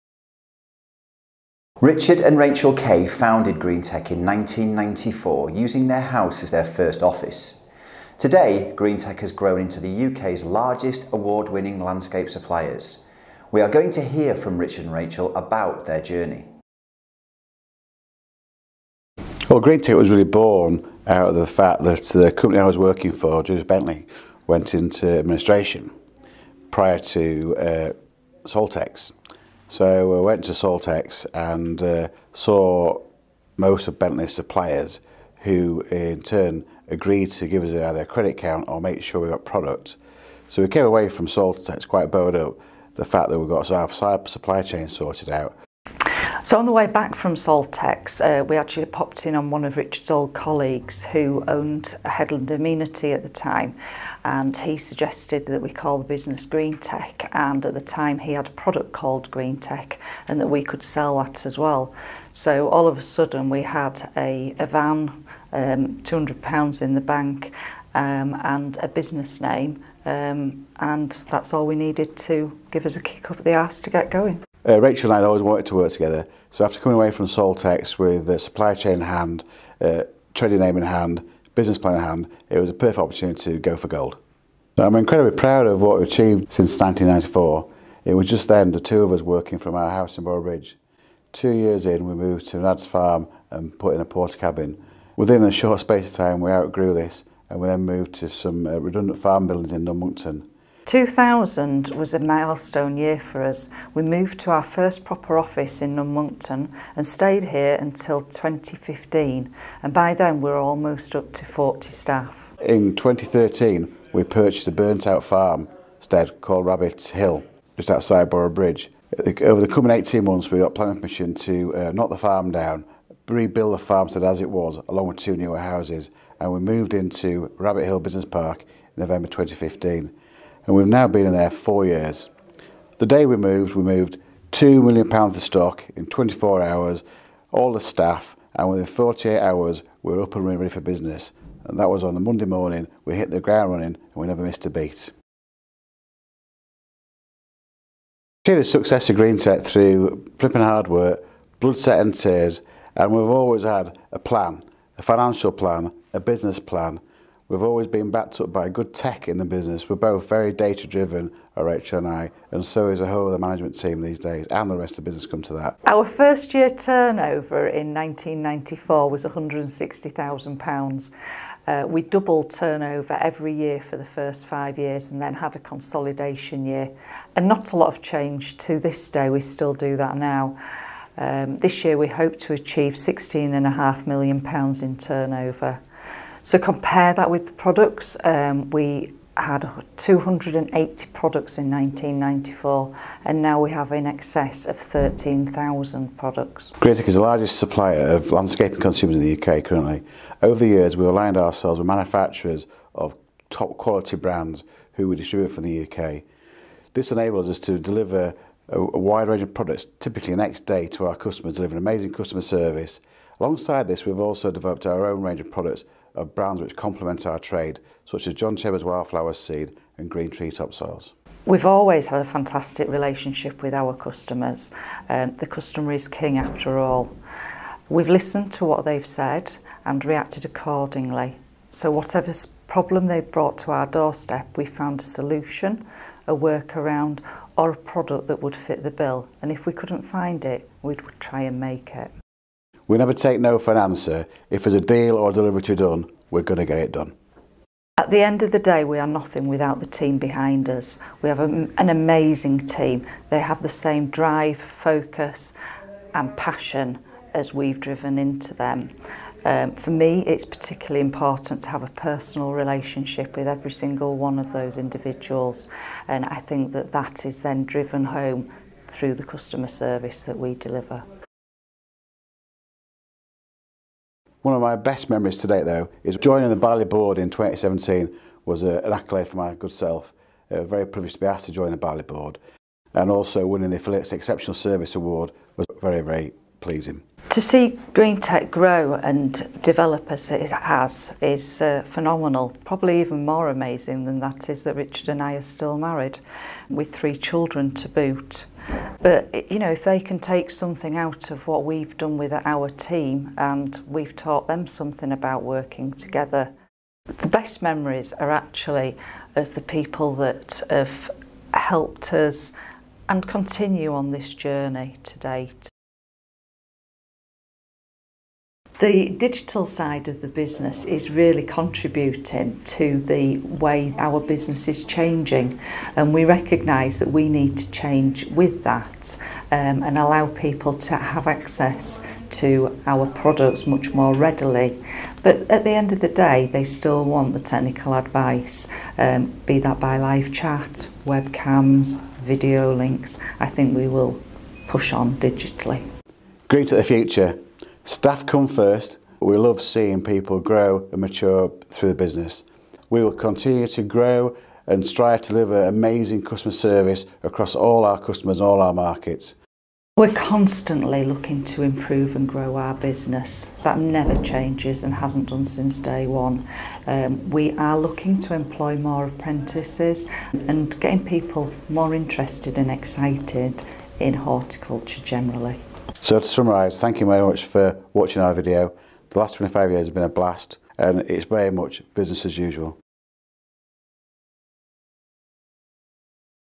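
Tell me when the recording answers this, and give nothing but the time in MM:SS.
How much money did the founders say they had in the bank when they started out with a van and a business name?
01:06.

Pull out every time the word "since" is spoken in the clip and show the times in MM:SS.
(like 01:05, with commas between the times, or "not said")
01:26, 06:05.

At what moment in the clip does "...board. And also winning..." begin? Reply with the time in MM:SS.
04:42.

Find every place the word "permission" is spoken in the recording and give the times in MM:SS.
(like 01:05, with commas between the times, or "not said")
02:00.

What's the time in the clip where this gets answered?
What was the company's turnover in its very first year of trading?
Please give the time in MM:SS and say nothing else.
02:49.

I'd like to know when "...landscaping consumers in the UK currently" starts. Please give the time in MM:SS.
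03:18.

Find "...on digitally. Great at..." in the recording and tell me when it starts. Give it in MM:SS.
05:44.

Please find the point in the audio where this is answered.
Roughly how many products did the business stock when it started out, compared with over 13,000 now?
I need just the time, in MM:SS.
03:09.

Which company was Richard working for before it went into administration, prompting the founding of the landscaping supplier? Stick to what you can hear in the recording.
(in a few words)
Julius Bentley.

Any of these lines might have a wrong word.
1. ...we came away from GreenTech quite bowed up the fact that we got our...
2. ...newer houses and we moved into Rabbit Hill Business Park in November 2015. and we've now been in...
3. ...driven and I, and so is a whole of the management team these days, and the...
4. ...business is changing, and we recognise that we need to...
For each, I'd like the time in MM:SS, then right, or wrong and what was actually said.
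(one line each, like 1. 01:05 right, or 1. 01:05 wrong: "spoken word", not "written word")
1. 00:40 wrong: "Saltex", not "GreenTech"
2. 02:05 right
3. 02:40 right
4. 05:24 right.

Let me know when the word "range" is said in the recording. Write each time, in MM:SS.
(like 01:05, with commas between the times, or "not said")
03:29, 03:35.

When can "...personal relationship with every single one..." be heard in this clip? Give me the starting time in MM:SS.
04:21.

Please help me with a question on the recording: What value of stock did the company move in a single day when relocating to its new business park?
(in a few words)
£2 million.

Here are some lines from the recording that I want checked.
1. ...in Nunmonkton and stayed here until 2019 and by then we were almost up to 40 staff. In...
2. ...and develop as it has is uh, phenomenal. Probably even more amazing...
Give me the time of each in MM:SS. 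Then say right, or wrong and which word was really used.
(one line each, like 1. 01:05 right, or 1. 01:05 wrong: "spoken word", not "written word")
1. 01:45 wrong: "2015", not "2019"
2. 04:48 right.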